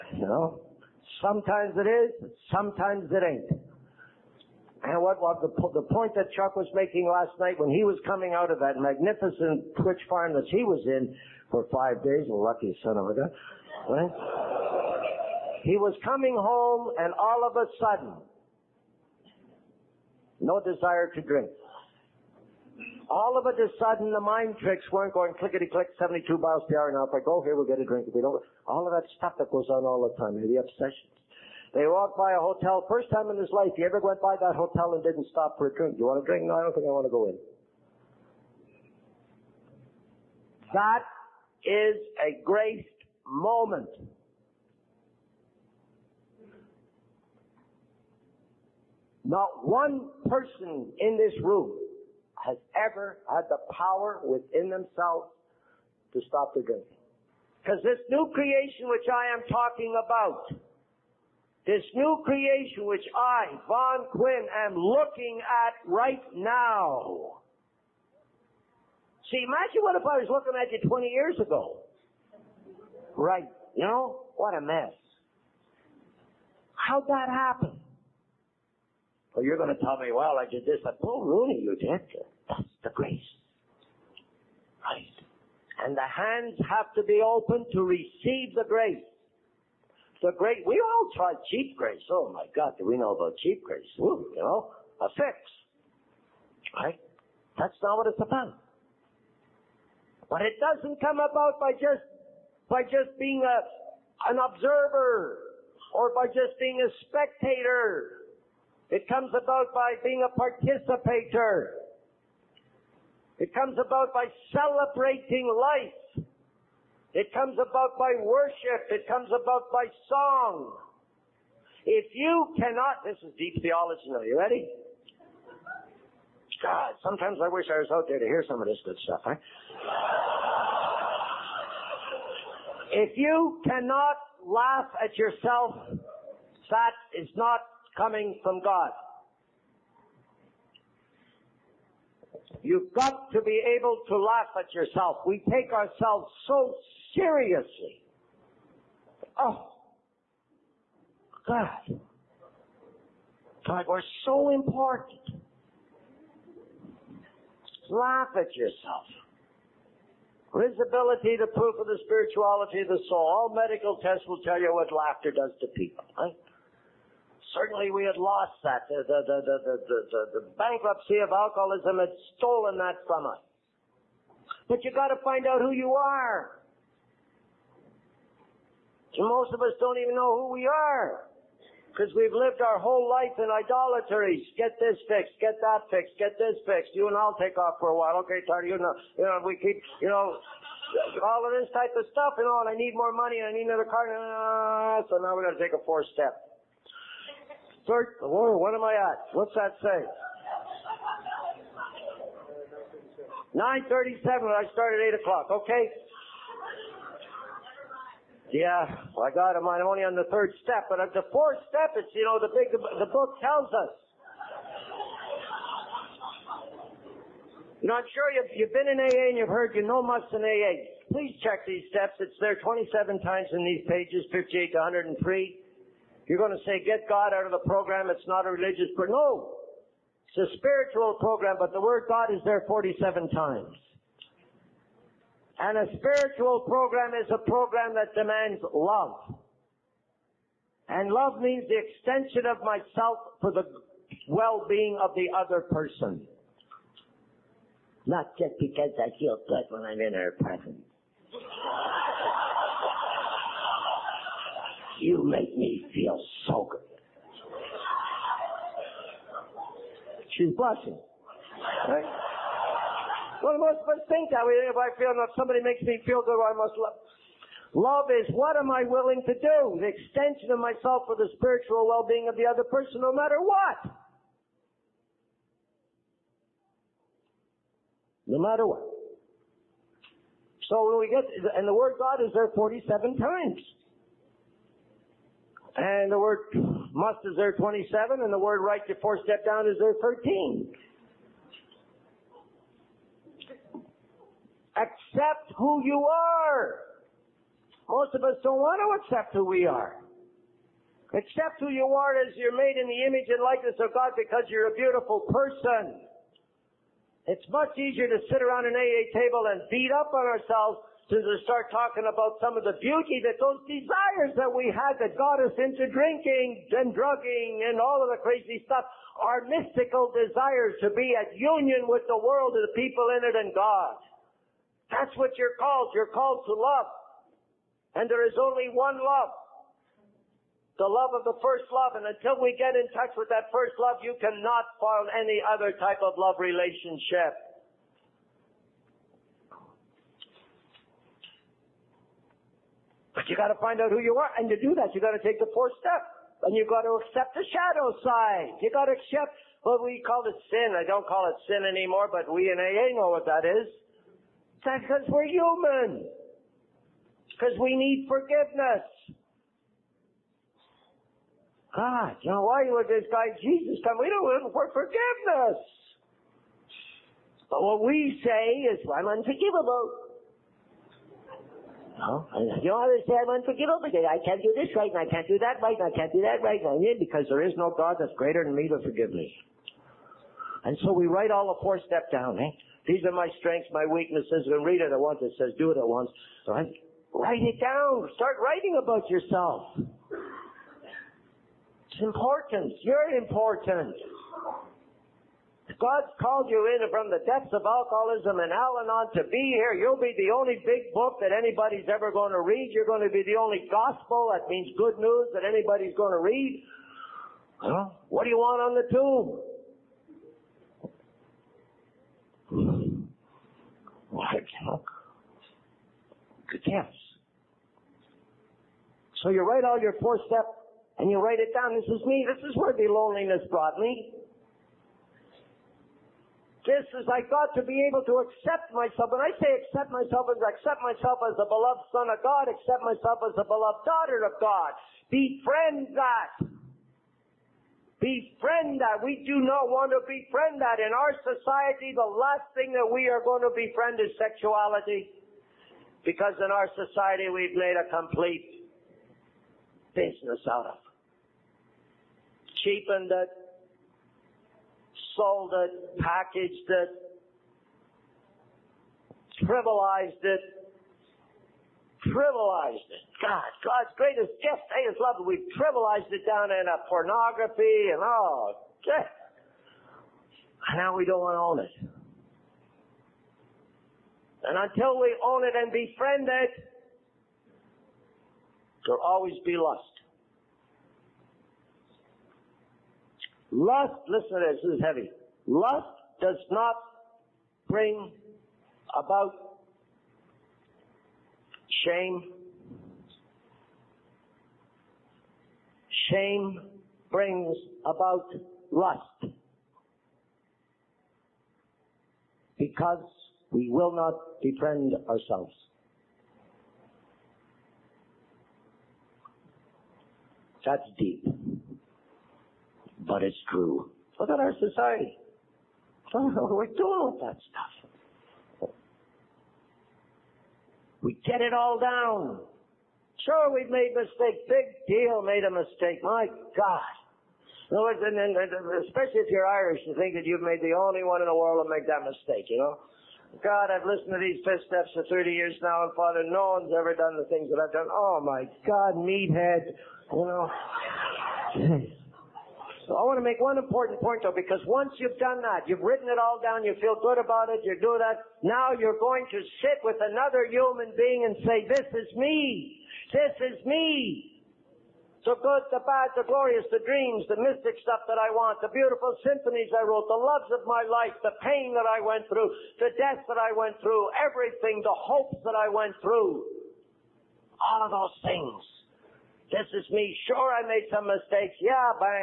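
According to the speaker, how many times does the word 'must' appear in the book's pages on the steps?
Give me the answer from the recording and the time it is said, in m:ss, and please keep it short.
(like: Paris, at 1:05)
27, at 3:42.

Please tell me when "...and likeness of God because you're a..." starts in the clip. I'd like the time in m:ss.
5:03.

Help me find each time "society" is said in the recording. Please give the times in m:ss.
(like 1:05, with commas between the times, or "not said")
7:21, 7:26, 8:34.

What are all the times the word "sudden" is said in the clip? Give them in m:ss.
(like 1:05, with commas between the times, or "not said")
0:17, 0:23.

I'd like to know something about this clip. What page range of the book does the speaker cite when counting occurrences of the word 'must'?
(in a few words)
58 to 103.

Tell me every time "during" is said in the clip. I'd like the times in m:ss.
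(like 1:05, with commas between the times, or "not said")
not said.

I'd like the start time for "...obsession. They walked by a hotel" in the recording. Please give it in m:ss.
0:30.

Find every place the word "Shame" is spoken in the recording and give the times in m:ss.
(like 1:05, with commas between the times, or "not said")
8:11, 8:16.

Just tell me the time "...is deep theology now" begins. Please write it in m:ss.
2:03.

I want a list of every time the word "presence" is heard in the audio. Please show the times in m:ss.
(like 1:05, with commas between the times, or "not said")
4:10.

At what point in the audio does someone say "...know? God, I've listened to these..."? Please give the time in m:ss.
8:52.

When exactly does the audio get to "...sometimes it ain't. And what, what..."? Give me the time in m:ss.
0:02.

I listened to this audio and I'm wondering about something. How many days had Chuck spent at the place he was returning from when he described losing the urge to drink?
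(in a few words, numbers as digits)
5.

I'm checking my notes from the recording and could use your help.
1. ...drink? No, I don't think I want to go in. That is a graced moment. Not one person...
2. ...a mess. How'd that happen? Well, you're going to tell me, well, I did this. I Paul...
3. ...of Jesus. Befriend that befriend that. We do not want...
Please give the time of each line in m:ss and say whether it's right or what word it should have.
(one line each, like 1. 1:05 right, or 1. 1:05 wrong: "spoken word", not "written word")
1. 0:36 right
2. 1:14 right
3. 7:14 wrong: "God", not "Jesus".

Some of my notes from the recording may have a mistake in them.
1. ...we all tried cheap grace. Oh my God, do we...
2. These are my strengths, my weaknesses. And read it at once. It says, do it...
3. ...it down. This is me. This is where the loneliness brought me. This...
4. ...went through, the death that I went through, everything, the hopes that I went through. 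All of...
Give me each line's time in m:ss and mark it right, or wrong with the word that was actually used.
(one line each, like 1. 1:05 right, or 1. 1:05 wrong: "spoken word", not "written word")
1. 1:30 right
2. 6:22 right
3. 7:01 right
4. 9:22 right.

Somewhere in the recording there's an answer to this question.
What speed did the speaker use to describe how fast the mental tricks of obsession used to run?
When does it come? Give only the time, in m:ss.
0:25.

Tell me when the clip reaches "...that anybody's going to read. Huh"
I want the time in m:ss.
6:45.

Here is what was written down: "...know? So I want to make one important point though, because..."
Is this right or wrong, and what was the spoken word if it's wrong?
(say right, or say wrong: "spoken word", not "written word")
right.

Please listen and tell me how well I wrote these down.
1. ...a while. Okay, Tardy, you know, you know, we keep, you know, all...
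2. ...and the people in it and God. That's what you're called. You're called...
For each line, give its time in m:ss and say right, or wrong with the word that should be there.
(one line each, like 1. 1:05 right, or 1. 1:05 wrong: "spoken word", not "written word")
1. 3:07 right
2. 5:22 right.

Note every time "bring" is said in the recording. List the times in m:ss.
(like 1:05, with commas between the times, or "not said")
8:07, 8:17.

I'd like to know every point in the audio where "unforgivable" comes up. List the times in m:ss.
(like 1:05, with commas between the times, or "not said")
6:09, 6:13.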